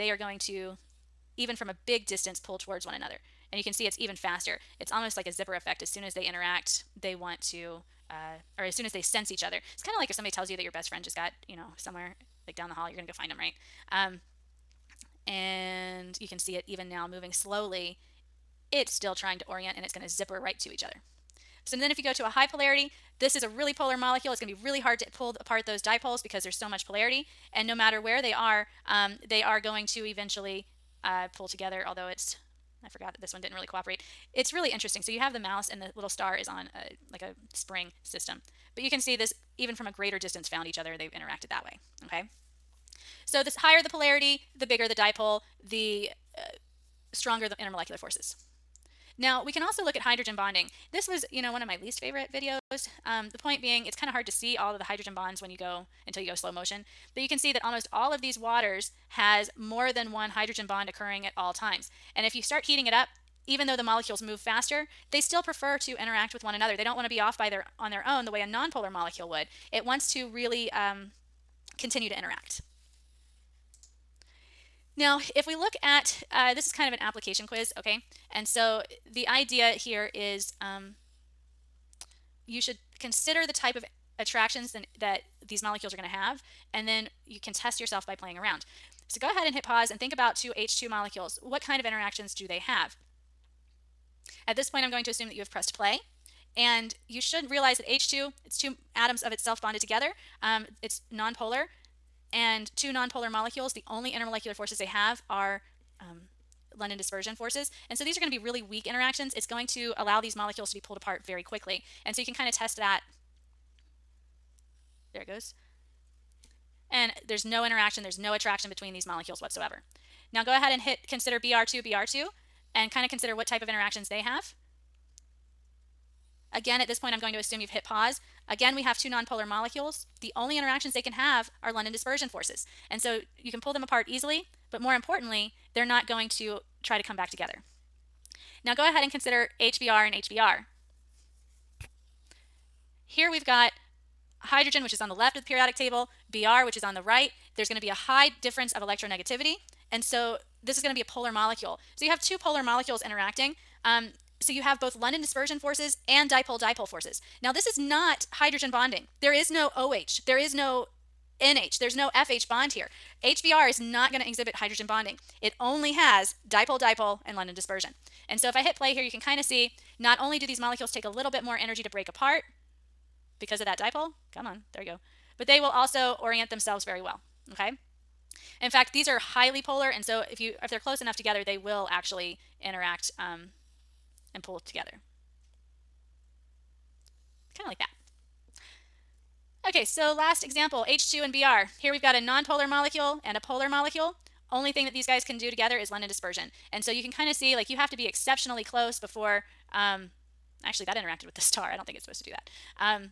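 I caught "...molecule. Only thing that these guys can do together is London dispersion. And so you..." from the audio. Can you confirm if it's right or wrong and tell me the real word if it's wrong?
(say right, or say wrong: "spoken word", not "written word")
right.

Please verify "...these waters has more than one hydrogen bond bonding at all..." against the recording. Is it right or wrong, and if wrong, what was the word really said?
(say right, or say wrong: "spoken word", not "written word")
wrong: "occurring", not "bonding".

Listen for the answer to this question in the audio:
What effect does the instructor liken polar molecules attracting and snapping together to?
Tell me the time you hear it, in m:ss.
0:05.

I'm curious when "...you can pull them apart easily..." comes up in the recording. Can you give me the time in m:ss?
2:13.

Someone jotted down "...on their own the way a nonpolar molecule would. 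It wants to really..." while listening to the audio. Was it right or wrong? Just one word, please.
right.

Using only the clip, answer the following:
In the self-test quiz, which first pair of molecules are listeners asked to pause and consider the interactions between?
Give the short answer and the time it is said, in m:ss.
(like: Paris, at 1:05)
Two H2 molecules, at 1:30.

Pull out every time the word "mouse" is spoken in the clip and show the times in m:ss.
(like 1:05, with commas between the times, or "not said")
0:35.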